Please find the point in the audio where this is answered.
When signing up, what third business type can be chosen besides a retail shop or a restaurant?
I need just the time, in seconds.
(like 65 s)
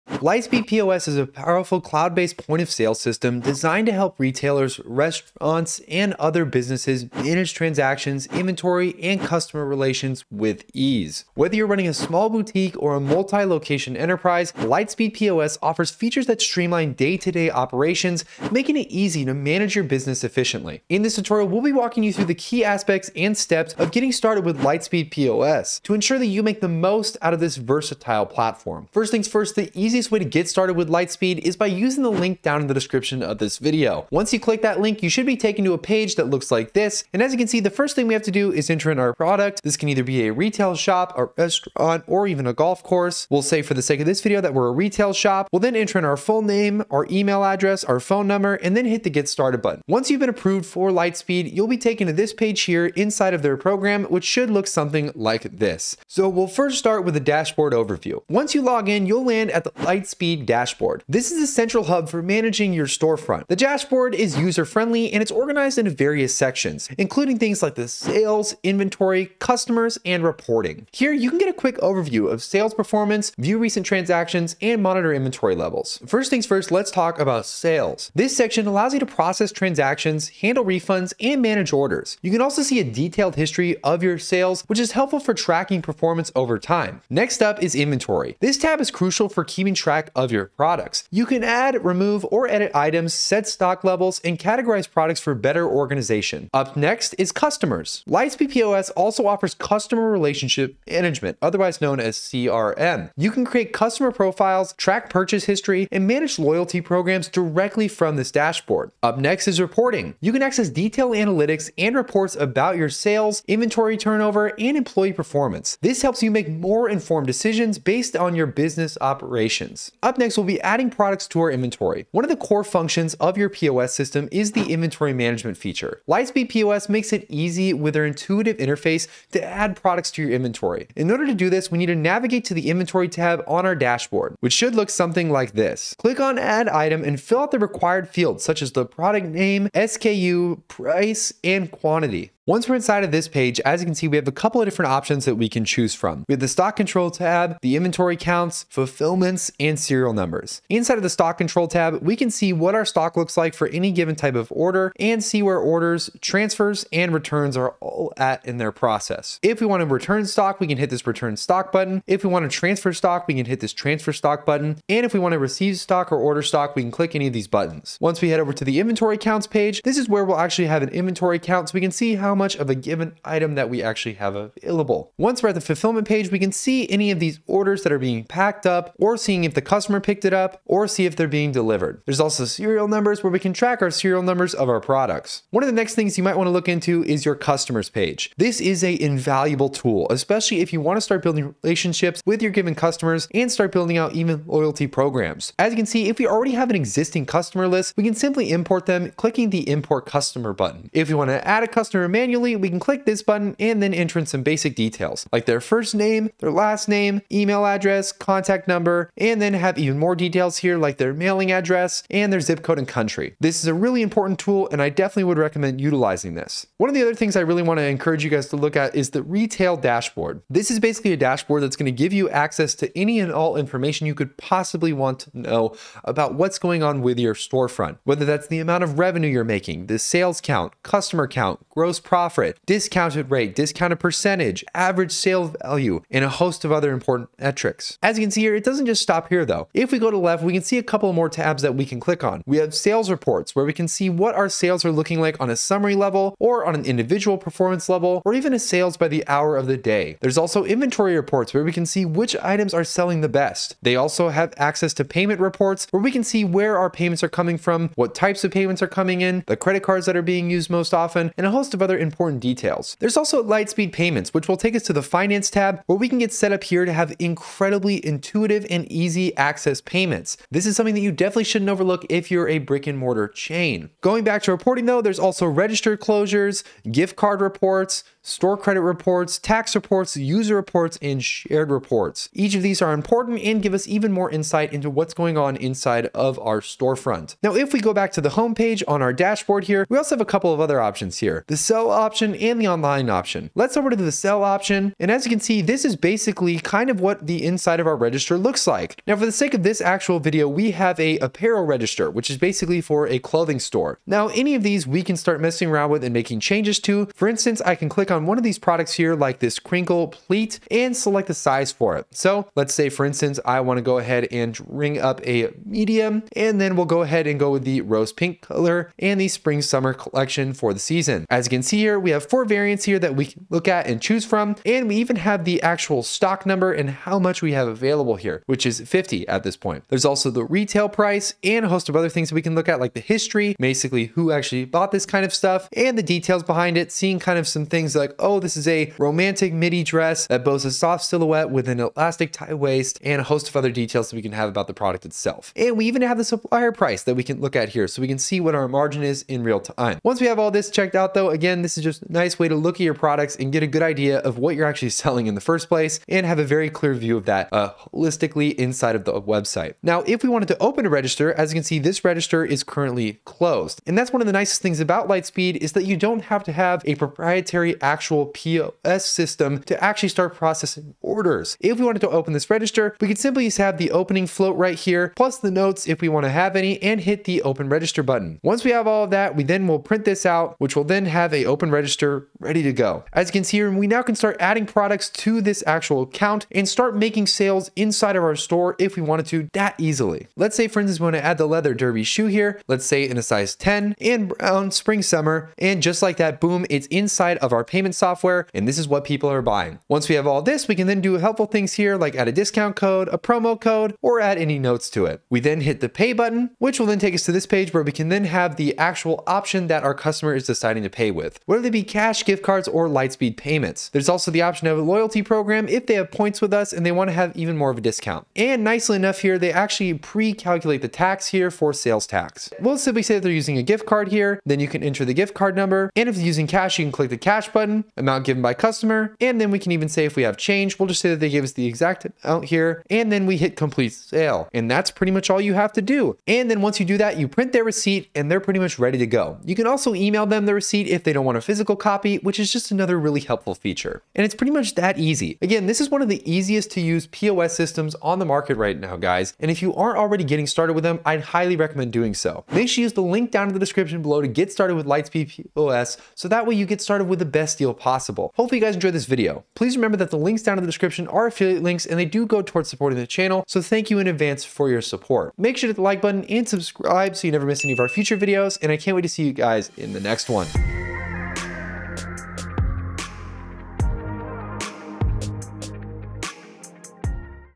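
42 s.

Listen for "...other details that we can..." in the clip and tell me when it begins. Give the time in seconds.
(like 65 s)
343 s.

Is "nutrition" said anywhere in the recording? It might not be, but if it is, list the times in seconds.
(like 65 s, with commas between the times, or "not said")
not said.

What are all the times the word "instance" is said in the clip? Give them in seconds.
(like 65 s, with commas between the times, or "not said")
307 s, 313 s, 390 s.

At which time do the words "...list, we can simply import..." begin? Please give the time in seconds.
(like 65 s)
197 s.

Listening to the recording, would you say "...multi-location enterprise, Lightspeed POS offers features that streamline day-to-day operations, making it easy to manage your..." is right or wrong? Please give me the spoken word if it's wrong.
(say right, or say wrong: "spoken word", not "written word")
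right.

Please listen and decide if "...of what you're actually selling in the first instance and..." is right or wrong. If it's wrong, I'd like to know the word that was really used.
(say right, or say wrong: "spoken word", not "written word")
wrong: "place", not "instance".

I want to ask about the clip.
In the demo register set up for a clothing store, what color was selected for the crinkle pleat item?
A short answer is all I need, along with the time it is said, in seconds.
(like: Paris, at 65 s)
rose pink, at 317 s.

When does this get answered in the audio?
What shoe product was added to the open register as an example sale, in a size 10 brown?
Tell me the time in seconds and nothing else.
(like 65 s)
391 s.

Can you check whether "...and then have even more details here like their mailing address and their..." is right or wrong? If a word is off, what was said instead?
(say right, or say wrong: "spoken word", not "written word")
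right.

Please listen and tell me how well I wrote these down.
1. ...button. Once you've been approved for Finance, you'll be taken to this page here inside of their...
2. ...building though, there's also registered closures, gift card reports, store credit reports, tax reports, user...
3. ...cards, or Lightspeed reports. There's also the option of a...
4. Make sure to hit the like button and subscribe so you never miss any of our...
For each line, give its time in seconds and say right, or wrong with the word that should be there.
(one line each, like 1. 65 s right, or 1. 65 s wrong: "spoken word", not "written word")
1. 49 s wrong: "Lightspeed", not "Finance"
2. 274 s wrong: "reporting", not "building"
3. 412 s wrong: "payments", not "reports"
4. 465 s right.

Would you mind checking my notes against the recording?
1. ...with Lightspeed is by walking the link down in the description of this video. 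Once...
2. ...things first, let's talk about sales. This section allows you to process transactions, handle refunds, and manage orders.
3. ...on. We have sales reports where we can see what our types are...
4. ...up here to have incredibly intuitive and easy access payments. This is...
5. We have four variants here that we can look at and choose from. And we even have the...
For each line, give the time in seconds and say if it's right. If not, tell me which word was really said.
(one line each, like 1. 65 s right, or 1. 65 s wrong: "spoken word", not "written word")
1. 30 s wrong: "using", not "walking"
2. 76 s right
3. 242 s wrong: "sales", not "types"
4. 266 s right
5. 321 s right.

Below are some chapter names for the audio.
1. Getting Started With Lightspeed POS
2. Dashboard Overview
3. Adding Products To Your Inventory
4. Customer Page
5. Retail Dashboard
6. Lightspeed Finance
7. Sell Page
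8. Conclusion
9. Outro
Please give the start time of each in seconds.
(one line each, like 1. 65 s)
1. 34 s
2. 55 s
3. 119 s
4. 185 s
5. 216 s
6. 262 s
7. 293 s
8. 443 s
9. 457 s.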